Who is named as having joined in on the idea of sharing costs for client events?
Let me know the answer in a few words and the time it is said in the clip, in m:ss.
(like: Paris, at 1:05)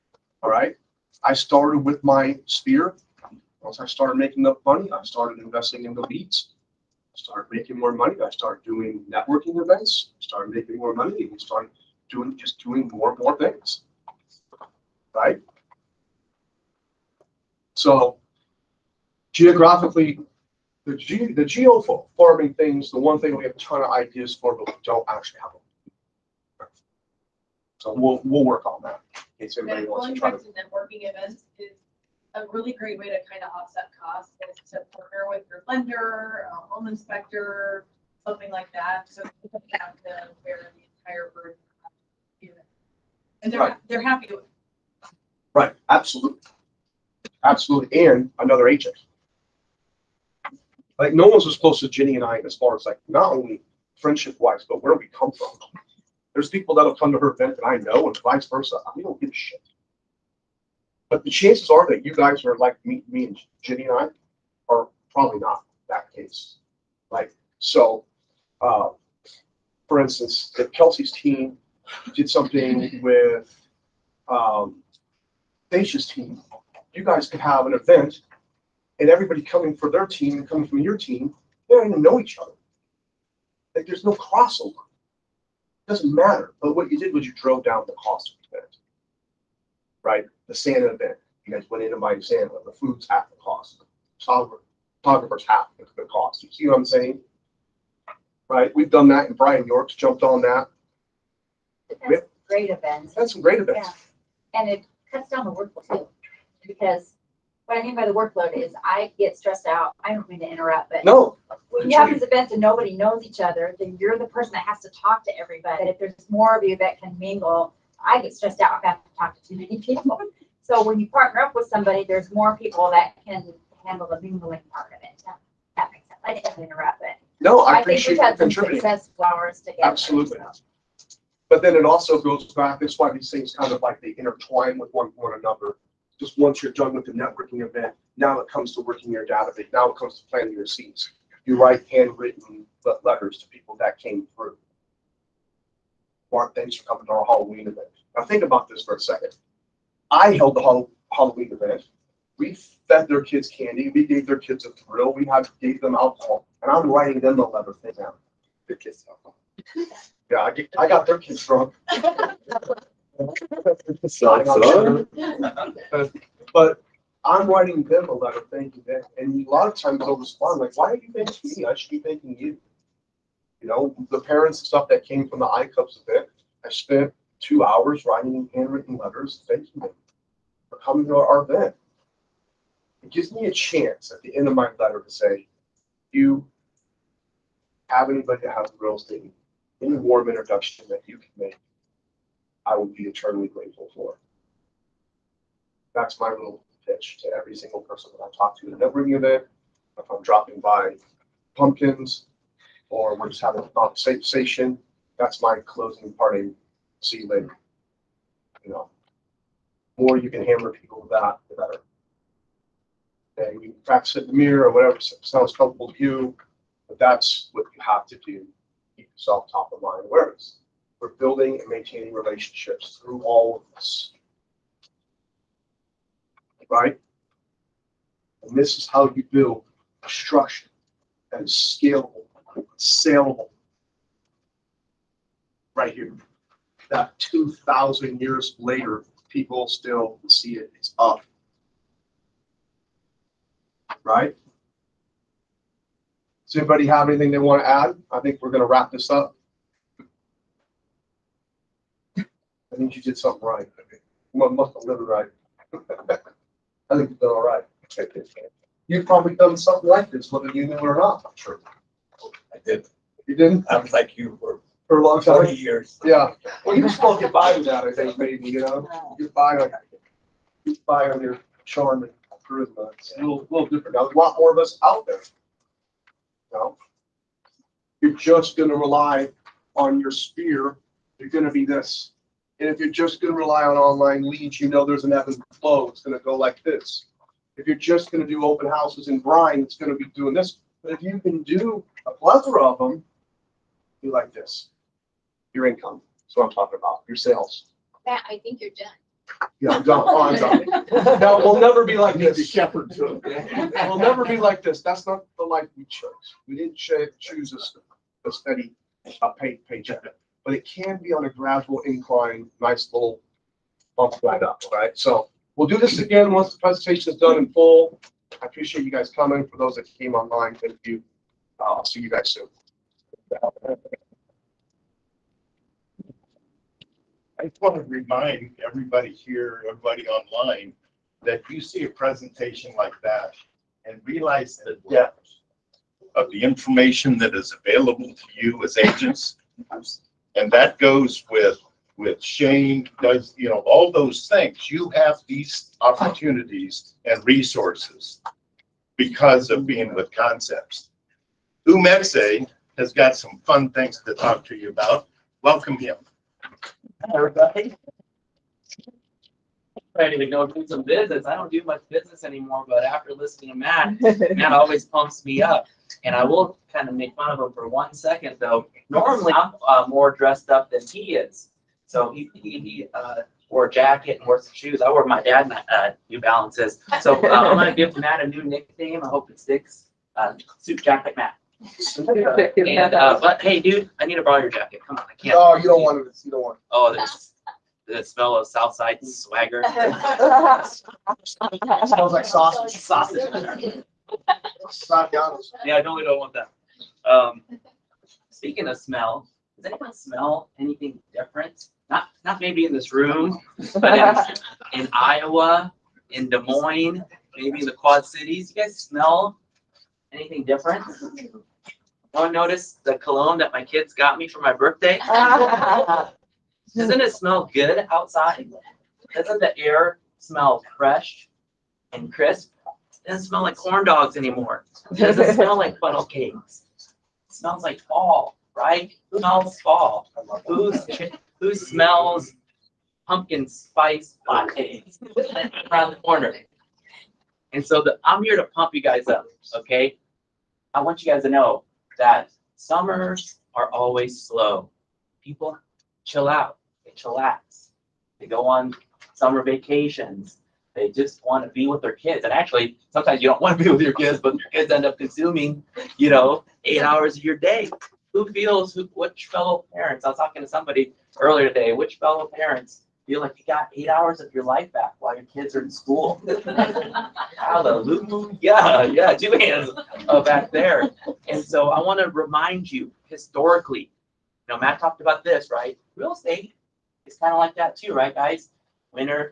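Brian York, at 1:39.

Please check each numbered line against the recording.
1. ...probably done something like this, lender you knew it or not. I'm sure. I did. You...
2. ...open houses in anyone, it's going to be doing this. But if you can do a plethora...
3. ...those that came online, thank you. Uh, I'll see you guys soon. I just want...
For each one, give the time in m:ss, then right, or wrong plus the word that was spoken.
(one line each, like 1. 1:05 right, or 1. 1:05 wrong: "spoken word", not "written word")
1. 4:19 wrong: "whether", not "lender"
2. 4:48 wrong: "brine", not "anyone"
3. 5:19 right.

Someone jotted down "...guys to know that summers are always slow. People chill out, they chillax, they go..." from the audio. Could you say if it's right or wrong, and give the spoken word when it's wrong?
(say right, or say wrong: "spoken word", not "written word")
right.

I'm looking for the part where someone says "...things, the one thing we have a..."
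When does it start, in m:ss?
0:22.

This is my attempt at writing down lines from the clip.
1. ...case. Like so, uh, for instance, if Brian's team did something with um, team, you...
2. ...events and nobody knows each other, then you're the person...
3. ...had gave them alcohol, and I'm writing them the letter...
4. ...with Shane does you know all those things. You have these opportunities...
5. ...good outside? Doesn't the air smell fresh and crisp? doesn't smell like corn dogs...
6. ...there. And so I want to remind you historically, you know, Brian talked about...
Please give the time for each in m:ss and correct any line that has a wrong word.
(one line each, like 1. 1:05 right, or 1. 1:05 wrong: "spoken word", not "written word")
1. 1:06 wrong: "Kelsey", not "Brian"
2. 1:52 right
3. 2:35 right
4. 5:41 right
5. 6:57 right
6. 7:50 wrong: "Matt", not "Brian".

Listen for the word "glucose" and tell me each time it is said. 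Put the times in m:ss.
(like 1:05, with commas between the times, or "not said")
not said.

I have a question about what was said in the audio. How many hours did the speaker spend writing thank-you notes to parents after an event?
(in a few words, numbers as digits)
2.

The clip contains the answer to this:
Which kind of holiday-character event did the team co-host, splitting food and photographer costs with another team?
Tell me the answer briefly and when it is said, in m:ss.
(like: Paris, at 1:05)
Santa event, at 1:30.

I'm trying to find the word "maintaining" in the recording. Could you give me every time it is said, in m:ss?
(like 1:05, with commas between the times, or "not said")
3:41.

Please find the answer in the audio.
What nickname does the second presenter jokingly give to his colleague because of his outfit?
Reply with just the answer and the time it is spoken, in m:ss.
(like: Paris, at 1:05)
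Suit jacket Matt, at 6:20.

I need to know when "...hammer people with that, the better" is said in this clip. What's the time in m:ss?
3:30.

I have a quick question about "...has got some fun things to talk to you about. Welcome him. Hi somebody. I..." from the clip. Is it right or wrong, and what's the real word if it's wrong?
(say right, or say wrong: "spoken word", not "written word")
wrong: "everybody", not "somebody".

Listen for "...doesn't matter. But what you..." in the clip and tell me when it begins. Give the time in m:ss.
1:25.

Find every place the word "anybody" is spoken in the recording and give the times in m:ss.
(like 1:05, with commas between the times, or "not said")
3:08, 4:06.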